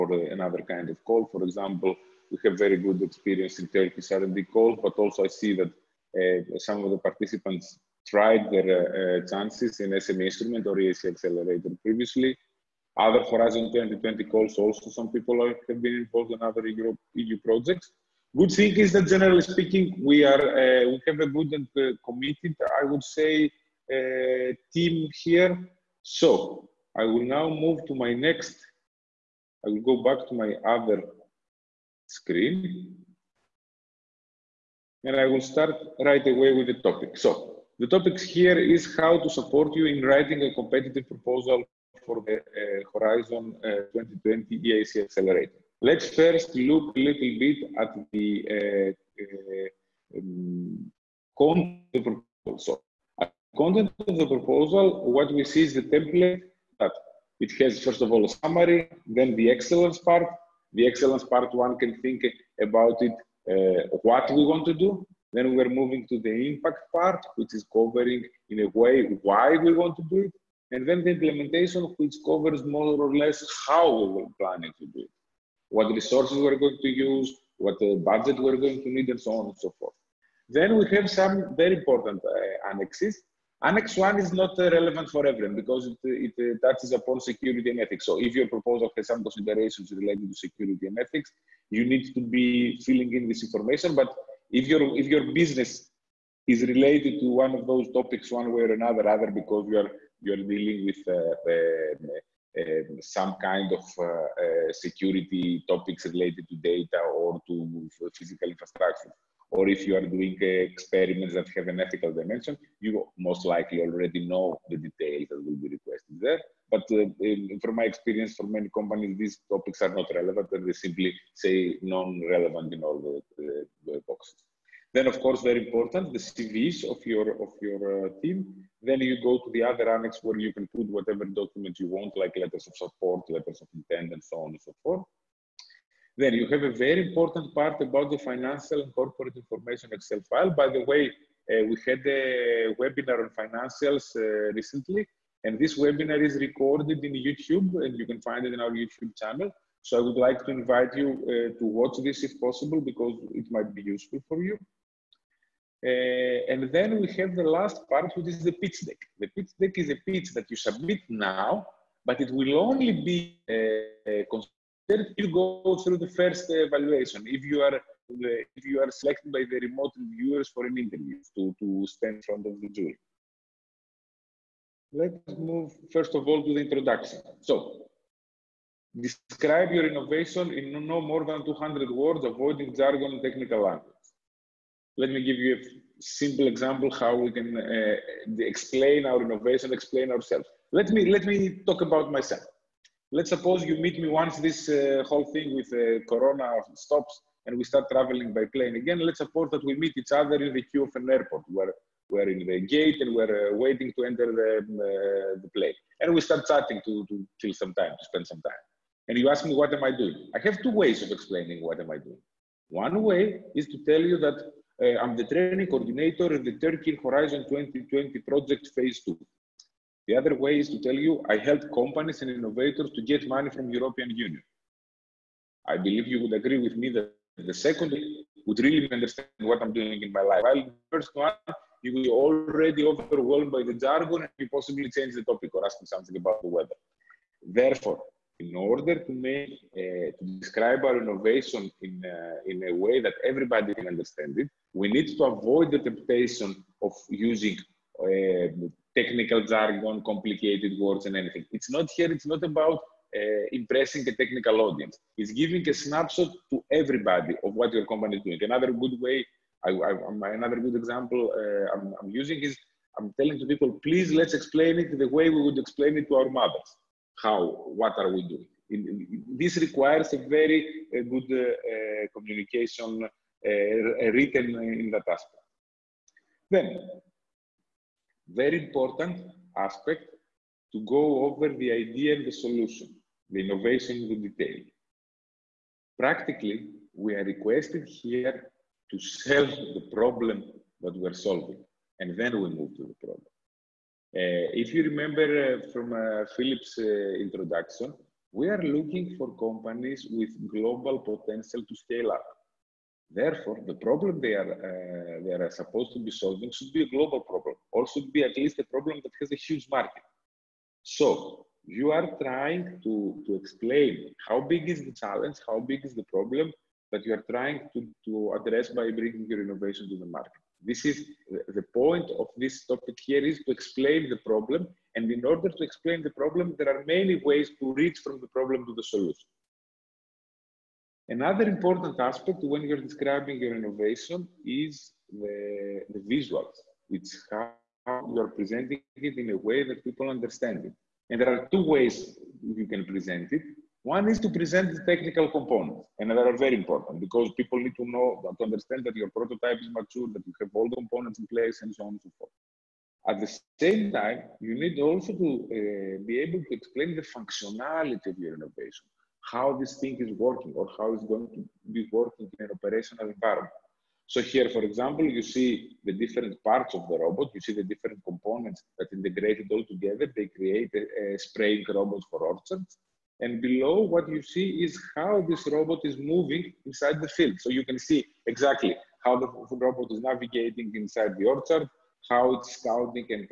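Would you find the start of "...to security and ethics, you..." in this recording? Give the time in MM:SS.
01:30.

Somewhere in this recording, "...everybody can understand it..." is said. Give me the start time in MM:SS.
04:03.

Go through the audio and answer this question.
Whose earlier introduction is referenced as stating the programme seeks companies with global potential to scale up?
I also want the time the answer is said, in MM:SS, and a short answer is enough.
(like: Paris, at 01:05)
Philip, at 04:56.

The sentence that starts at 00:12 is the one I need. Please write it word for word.
Other Horizon 2020 calls also some people are, have been involved in other EU EU projects.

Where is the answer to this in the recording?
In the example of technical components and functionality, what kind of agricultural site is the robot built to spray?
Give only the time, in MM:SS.
06:12.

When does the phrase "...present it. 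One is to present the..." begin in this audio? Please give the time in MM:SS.
05:42.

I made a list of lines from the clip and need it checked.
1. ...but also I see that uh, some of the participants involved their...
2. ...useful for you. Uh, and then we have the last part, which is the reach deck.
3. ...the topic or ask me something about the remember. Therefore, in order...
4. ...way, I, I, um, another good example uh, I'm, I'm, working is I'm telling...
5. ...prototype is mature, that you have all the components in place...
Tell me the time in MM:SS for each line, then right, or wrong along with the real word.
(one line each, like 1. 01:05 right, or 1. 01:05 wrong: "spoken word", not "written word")
1. 00:04 wrong: "tried", not "involved"
2. 02:33 wrong: "pitch", not "reach"
3. 03:55 wrong: "weather", not "remember"
4. 04:18 wrong: "using", not "working"
5. 05:49 right.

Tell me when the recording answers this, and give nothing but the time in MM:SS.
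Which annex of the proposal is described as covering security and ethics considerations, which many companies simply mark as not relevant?
01:23.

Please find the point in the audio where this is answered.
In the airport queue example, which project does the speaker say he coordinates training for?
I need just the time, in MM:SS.
03:36.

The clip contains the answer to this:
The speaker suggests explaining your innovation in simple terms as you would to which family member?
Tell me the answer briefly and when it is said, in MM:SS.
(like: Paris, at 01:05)
mothers, at 04:26.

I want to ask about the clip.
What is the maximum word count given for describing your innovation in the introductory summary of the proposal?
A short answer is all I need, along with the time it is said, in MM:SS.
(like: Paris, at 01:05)
200, at 03:01.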